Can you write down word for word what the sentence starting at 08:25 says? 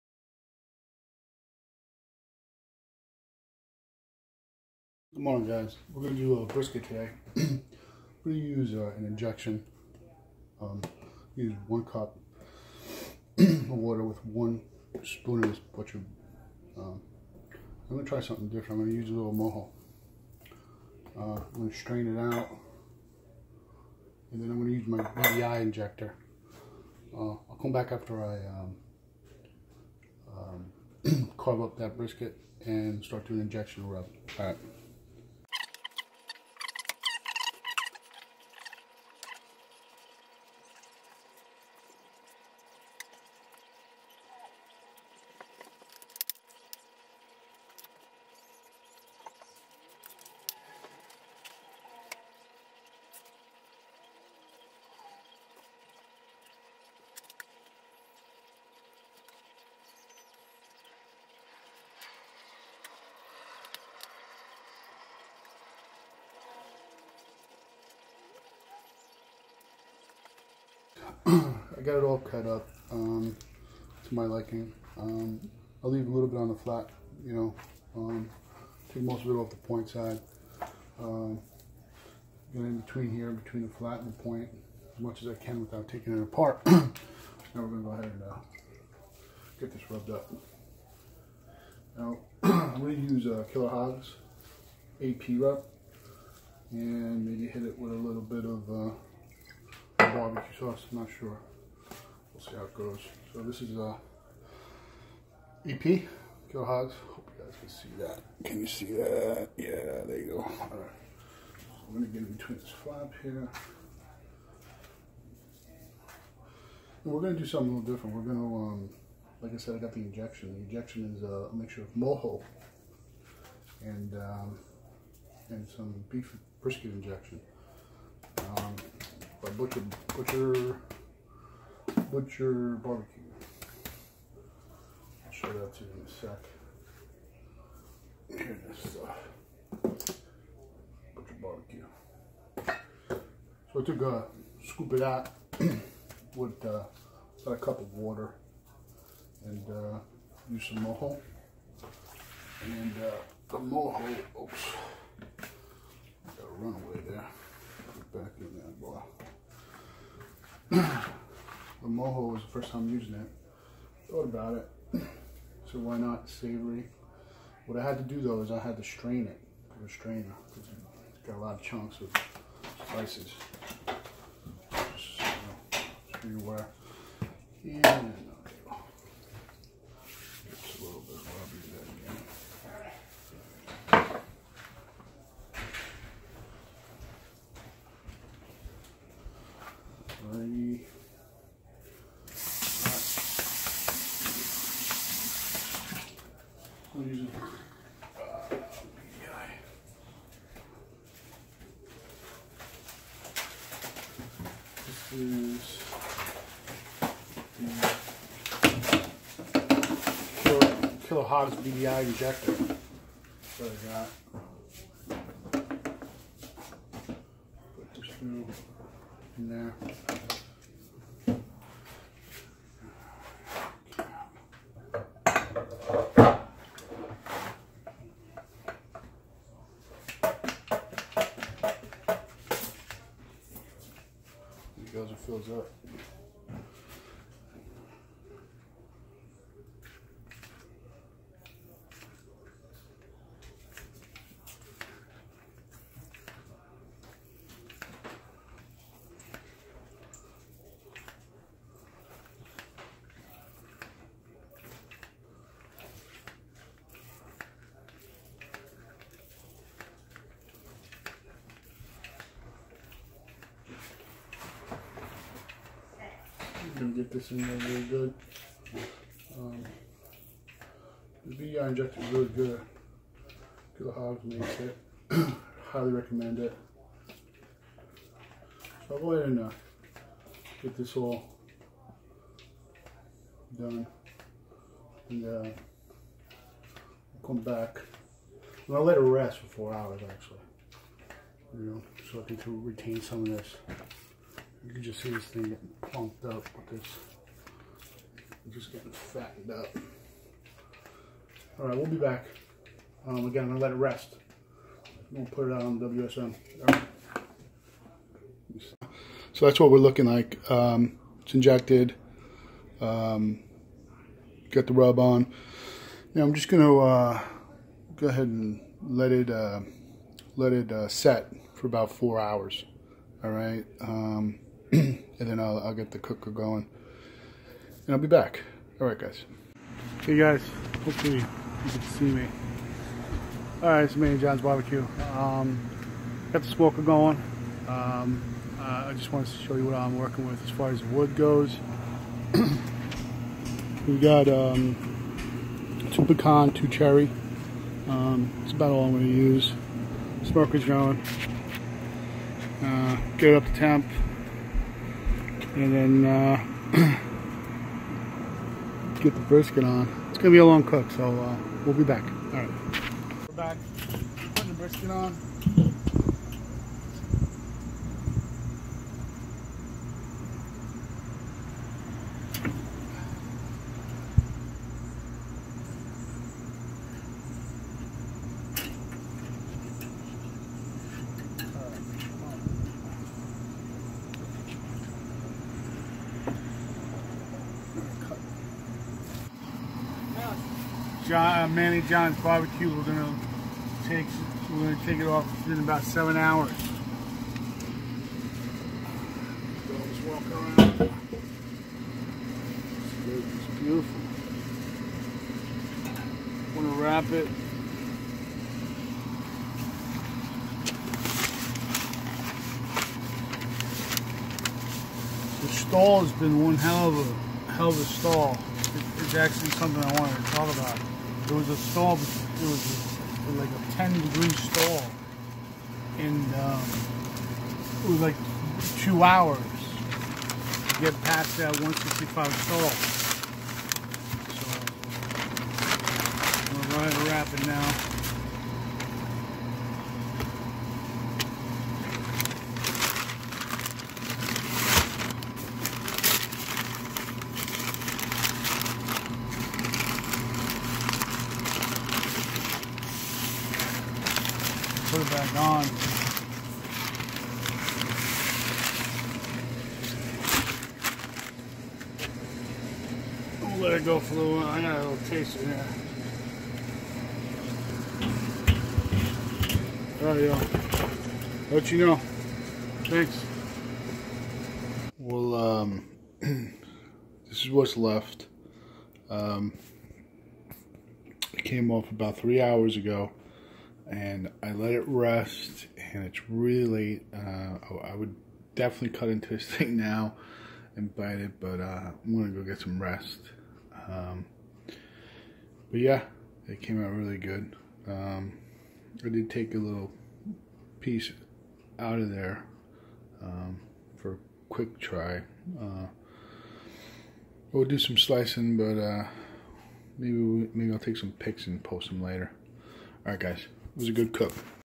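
Uh, we'll do some slicing, but uh, maybe we, maybe I'll take some pics and post them later.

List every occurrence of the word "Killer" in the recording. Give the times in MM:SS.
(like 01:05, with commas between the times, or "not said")
01:33, 01:46, 03:31.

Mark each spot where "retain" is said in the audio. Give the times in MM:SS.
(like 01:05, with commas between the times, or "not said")
04:52.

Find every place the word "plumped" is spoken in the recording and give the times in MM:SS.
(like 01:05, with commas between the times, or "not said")
04:55.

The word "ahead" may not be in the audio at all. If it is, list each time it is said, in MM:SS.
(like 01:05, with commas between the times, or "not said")
01:27, 04:39, 05:18.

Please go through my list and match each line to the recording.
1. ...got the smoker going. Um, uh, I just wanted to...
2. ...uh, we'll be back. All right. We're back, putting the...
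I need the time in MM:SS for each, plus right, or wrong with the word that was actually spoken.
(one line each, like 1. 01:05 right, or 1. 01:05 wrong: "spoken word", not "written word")
1. 05:36 right
2. 06:01 right.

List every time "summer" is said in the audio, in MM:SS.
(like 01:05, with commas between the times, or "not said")
not said.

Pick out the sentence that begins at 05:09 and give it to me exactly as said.
So that's what we're looking like.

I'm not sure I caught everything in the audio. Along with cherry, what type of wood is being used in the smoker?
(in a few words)
Pecan.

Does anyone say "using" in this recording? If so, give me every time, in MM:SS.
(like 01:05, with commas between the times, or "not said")
02:42, 03:17.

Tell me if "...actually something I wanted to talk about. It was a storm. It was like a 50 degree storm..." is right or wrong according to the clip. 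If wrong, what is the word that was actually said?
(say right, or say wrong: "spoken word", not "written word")
wrong: "10", not "50".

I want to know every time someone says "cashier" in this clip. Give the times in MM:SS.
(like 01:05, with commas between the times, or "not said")
not said.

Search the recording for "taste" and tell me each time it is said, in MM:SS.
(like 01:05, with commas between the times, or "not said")
07:45.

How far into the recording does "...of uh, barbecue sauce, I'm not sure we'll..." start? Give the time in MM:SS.
01:38.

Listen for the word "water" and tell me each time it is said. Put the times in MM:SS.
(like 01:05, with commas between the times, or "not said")
00:13, 02:27.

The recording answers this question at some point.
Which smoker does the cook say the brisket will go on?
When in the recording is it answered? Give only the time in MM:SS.
05:05.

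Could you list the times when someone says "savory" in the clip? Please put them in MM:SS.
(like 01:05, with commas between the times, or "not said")
02:46.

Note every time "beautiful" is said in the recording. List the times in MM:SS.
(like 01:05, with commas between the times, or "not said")
06:43.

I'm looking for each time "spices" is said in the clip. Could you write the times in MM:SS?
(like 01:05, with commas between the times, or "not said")
02:52.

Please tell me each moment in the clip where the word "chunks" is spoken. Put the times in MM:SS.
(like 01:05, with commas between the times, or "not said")
02:51.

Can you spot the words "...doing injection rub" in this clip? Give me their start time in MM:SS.
00:33.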